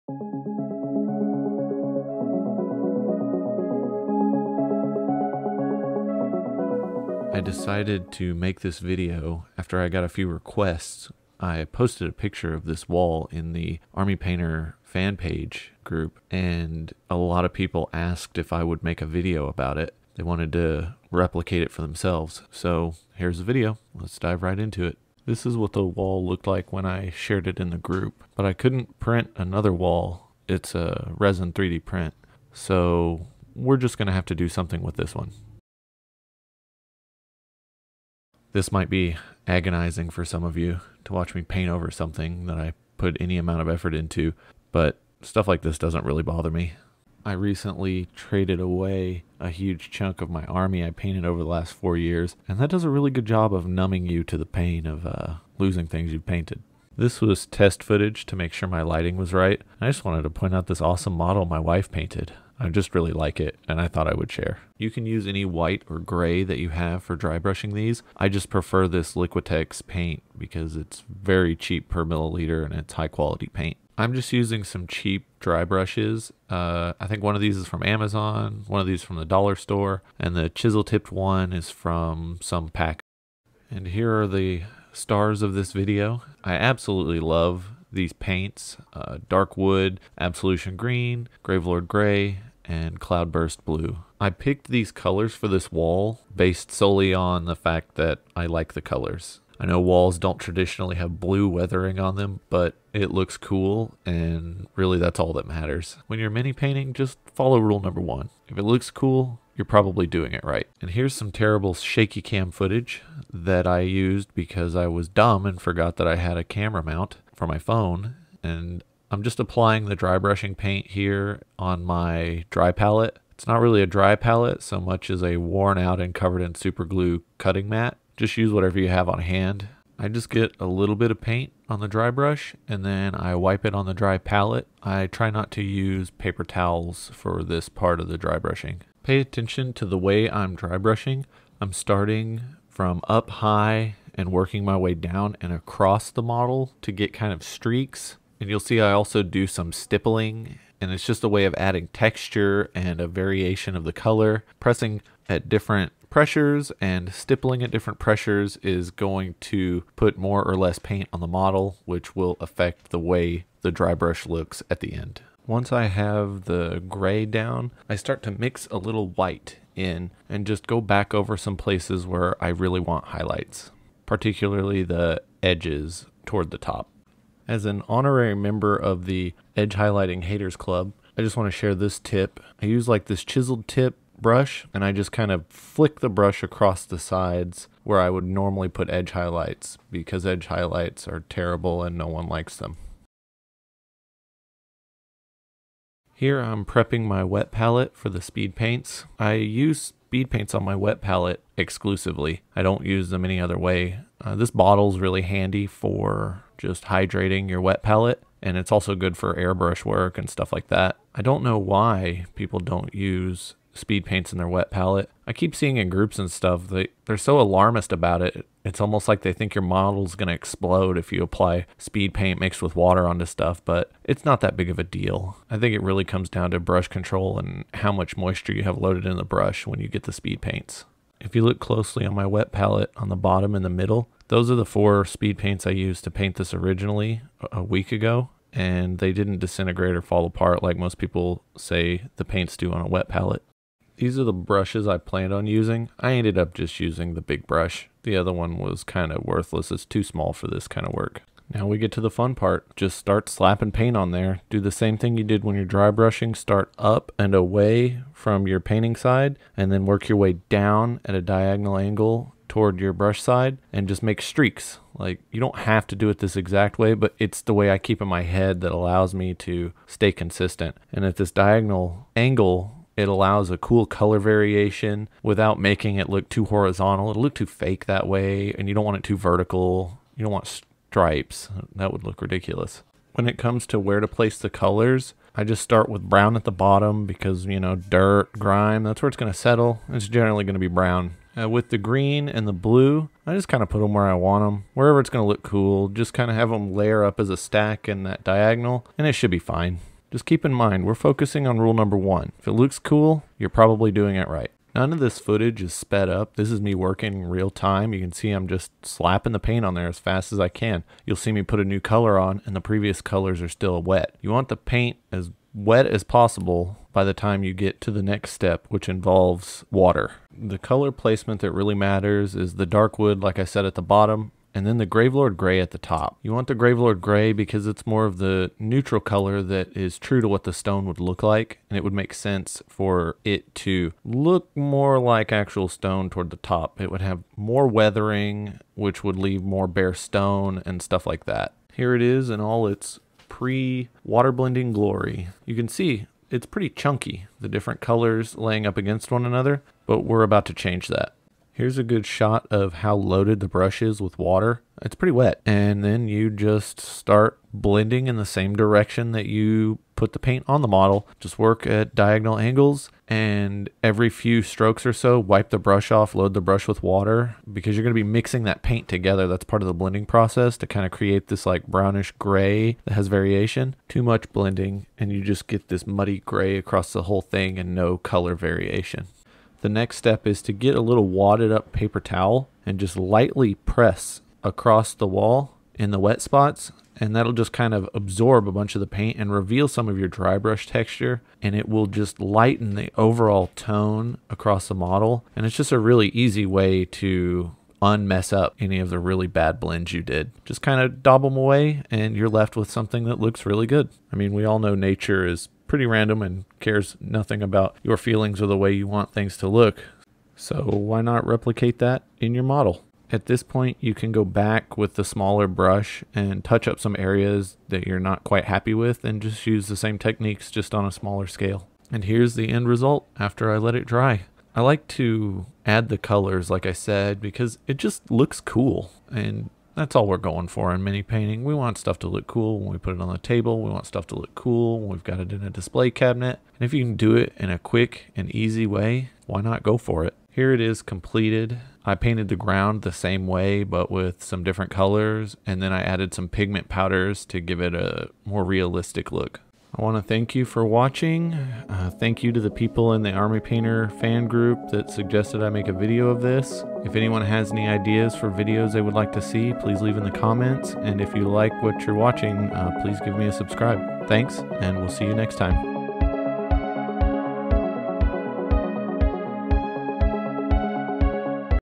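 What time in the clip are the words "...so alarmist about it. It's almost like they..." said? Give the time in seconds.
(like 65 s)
217 s.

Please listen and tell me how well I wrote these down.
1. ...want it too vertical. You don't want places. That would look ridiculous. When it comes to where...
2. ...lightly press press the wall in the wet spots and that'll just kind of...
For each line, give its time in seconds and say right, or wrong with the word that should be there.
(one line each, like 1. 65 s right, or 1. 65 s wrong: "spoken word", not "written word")
1. 278 s wrong: "stripes", not "places"
2. 382 s wrong: "across", not "press".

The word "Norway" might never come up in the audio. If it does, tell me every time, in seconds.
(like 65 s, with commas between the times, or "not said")
not said.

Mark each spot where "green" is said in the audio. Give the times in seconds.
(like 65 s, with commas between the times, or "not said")
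90 s, 291 s.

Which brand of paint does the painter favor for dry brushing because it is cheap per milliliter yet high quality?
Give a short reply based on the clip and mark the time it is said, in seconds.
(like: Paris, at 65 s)
Liquitex, at 69 s.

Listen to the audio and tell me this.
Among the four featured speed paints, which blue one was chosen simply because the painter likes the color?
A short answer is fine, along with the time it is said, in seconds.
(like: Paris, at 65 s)
Cloudburst Blue, at 92 s.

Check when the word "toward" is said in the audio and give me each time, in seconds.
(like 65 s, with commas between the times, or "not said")
176 s, 262 s, 336 s.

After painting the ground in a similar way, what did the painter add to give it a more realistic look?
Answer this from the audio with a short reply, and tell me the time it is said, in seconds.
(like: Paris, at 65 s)
pigment powders, at 446 s.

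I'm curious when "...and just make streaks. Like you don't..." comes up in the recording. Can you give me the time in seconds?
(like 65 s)
263 s.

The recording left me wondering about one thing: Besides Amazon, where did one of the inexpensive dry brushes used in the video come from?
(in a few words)
the dollar store.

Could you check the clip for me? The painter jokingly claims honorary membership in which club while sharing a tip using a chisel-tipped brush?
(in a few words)
Edge Highlighting Haters Club.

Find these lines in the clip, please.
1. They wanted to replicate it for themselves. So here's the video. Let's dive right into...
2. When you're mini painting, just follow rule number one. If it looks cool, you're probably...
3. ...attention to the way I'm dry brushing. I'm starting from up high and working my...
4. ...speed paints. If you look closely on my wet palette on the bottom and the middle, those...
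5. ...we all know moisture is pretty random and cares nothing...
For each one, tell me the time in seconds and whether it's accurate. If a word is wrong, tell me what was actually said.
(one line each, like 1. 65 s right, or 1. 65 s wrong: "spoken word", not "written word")
1. 20 s right
2. 106 s right
3. 139 s right
4. 230 s right
5. 404 s wrong: "nature", not "moisture".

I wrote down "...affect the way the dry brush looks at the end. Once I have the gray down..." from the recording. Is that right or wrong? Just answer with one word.
right.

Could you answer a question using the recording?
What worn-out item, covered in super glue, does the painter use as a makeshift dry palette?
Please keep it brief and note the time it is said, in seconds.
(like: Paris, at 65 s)
cutting mat, at 127 s.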